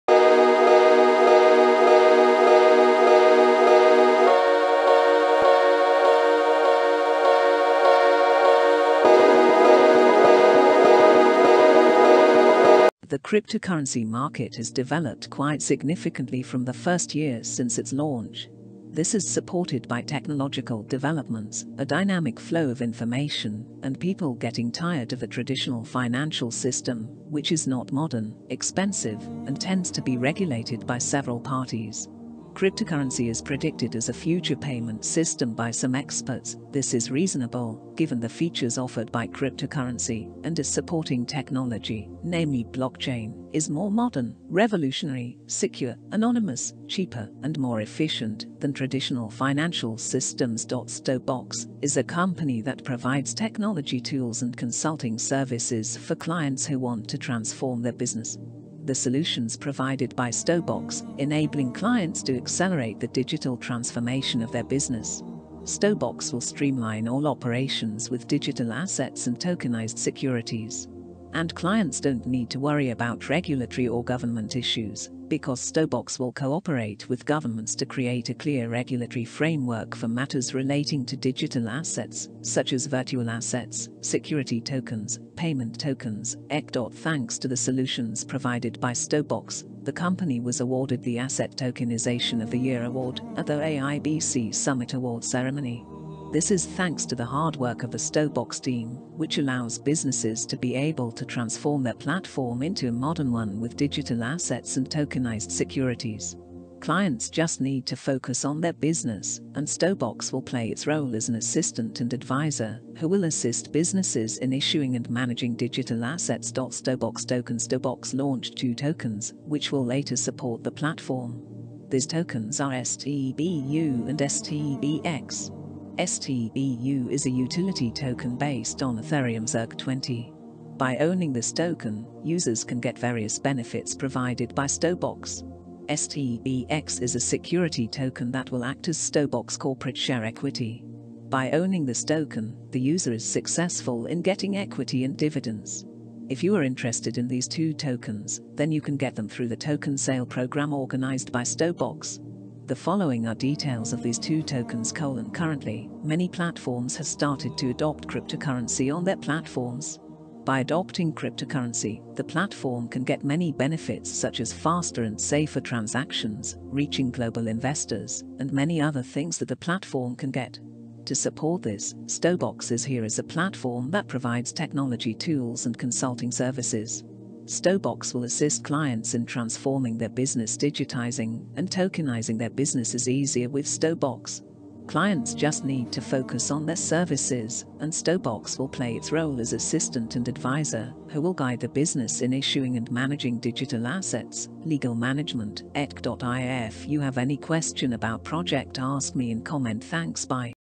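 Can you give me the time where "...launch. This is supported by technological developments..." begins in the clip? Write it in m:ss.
0:17.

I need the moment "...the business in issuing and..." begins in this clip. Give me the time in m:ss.
3:11.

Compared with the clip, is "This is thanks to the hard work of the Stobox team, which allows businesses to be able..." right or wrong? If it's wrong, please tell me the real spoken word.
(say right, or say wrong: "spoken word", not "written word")
right.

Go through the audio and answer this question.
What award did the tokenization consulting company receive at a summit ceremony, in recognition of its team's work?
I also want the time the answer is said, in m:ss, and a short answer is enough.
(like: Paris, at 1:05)
Asset Tokenization of the Year, at 1:31.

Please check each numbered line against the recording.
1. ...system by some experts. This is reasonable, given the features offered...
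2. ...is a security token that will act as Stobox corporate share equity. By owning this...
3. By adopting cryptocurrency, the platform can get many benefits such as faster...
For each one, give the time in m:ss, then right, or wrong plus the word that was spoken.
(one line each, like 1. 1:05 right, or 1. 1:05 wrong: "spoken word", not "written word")
1. 0:35 right
2. 2:17 right
3. 2:40 right.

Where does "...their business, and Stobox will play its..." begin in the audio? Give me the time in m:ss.
1:48.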